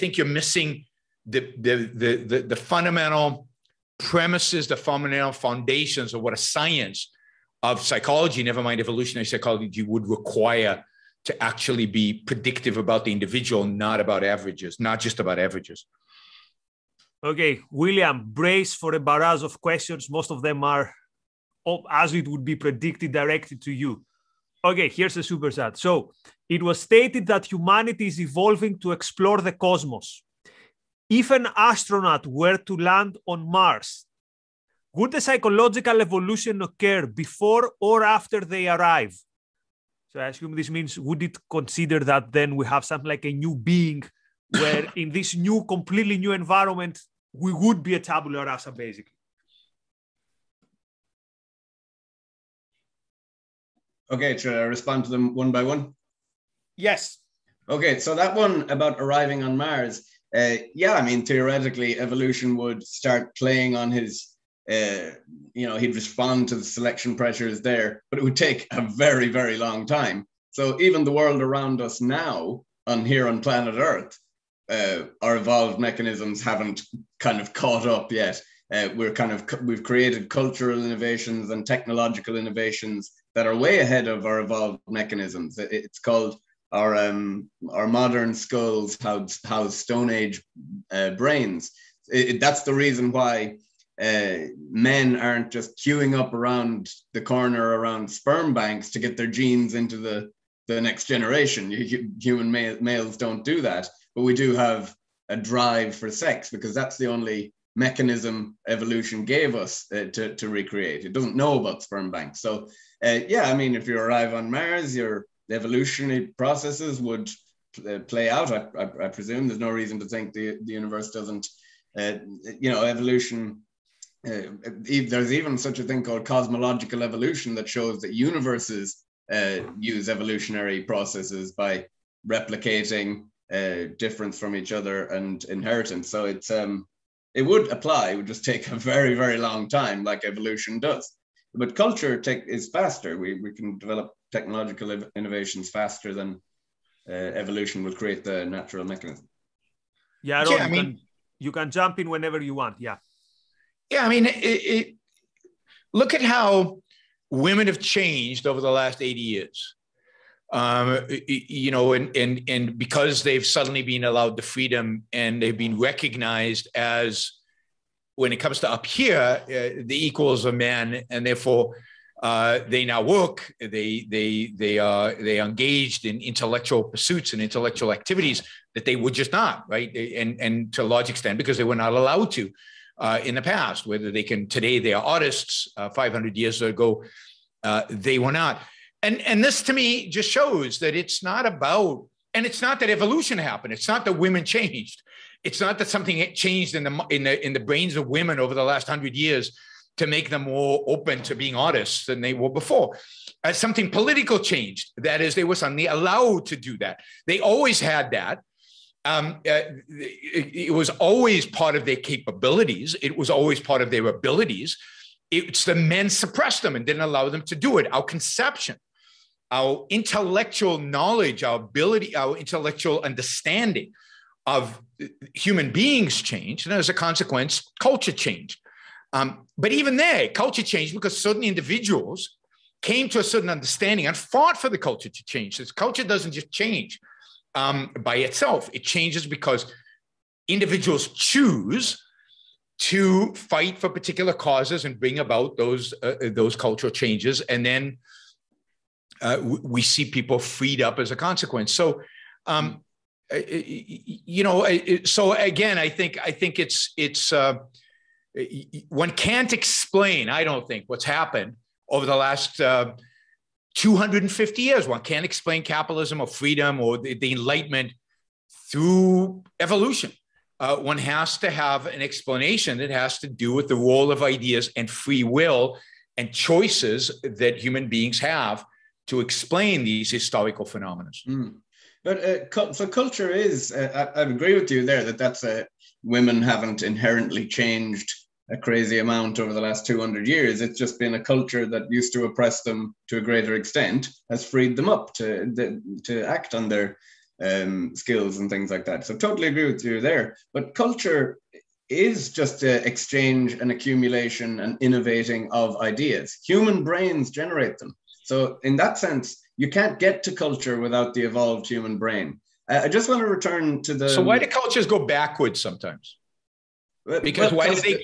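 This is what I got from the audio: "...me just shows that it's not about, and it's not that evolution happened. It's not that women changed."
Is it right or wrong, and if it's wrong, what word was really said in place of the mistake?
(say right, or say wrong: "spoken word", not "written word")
right.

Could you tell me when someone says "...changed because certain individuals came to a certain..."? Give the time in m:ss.
3:50.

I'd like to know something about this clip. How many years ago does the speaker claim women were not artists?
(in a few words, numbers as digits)
500.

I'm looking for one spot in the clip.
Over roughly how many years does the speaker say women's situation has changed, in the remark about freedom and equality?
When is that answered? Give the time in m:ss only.
2:39.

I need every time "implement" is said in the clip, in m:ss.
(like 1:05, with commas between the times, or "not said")
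not said.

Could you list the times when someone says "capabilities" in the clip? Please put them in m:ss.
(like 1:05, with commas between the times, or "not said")
3:31.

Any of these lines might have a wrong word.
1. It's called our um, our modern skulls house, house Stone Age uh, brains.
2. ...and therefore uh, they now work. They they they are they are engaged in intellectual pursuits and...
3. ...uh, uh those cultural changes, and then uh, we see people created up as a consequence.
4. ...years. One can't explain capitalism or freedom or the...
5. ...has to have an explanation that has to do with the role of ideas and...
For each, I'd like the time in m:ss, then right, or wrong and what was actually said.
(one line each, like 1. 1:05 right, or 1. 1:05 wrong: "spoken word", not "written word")
1. 1:25 right
2. 2:51 right
3. 4:06 wrong: "freed", not "created"
4. 4:24 right
5. 4:30 right.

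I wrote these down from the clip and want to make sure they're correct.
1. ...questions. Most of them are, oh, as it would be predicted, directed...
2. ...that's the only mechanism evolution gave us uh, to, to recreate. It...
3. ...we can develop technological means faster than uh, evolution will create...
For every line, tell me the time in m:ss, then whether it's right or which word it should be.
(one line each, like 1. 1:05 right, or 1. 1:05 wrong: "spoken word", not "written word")
1. 0:19 right
2. 1:46 right
3. 2:23 wrong: "innovations", not "means".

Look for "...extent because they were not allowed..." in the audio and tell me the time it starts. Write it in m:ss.
3:01.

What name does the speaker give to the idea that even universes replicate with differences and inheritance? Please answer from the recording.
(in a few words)
cosmological evolution.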